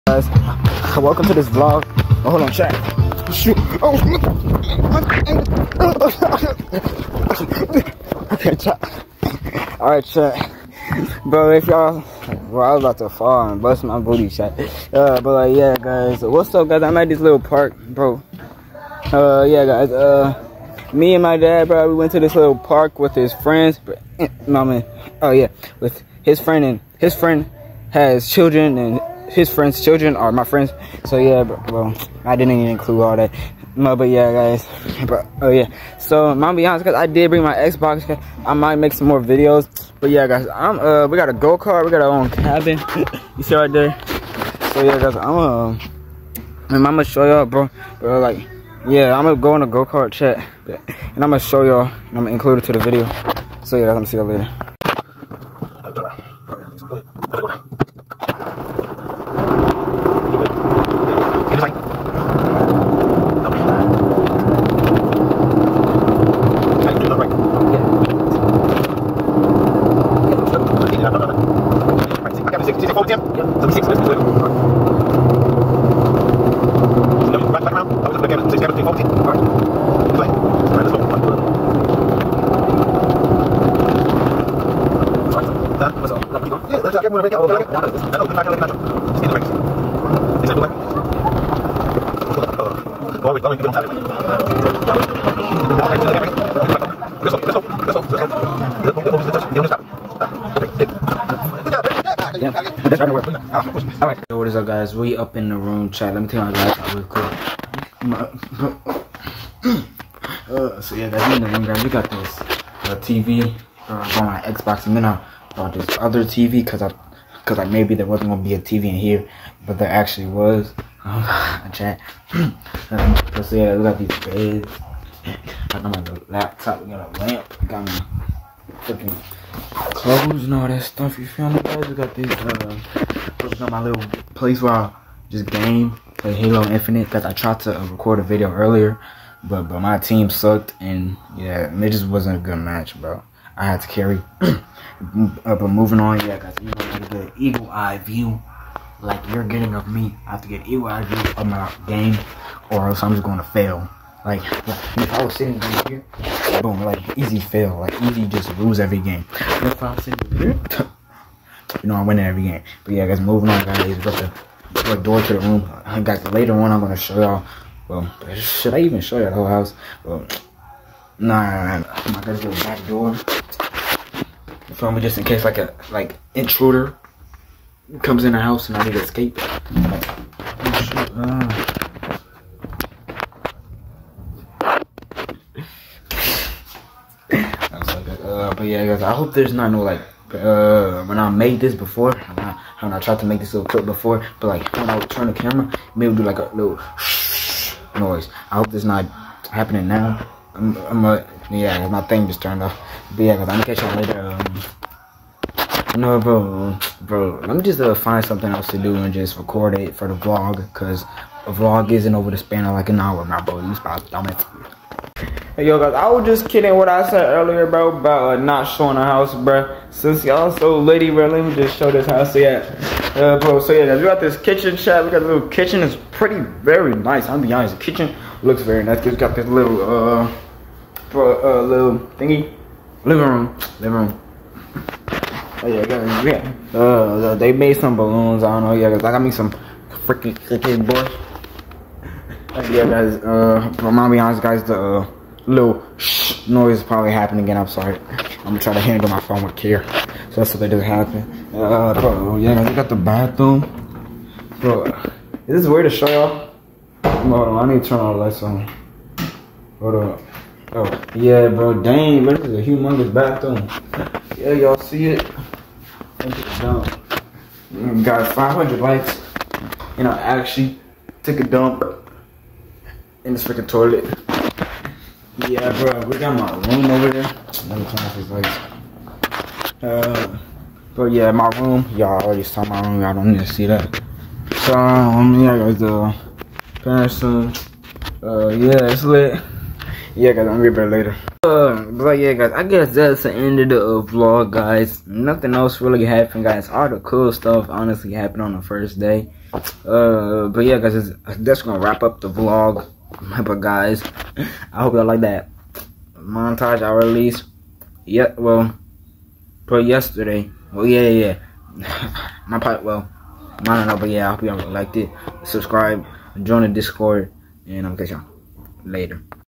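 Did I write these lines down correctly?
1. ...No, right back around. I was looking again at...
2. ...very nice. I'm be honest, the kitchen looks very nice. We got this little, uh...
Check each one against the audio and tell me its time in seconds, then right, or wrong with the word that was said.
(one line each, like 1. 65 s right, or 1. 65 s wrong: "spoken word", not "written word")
1. 74 s right
2. 226 s right.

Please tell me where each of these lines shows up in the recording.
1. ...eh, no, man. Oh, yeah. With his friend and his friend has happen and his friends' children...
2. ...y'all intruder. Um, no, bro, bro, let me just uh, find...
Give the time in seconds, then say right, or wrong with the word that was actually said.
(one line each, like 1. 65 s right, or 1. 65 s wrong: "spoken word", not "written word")
1. 24 s wrong: "children", not "happen"
2. 203 s wrong: "later", not "intruder".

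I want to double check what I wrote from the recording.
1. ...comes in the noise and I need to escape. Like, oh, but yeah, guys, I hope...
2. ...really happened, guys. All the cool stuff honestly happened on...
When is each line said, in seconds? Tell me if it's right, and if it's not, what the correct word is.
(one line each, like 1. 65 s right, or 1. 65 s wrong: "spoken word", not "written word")
1. 178 s wrong: "house", not "noise"
2. 295 s right.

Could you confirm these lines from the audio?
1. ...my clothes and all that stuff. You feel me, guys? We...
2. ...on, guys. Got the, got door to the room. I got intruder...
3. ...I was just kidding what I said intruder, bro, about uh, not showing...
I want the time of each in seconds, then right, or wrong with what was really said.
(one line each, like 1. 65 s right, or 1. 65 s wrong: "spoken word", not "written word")
1. 127 s right
2. 163 s wrong: "later", not "intruder"
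3. 215 s wrong: "earlier", not "intruder".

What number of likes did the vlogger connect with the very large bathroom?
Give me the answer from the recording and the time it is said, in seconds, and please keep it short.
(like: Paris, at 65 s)
500, at 268 s.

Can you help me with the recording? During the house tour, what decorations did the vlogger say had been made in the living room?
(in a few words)
balloons.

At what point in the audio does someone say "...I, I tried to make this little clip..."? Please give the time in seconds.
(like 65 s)
192 s.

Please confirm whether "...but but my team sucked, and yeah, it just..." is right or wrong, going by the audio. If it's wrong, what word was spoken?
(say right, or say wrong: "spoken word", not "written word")
right.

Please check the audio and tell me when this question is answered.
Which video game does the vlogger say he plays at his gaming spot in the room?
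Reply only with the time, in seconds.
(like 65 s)
136 s.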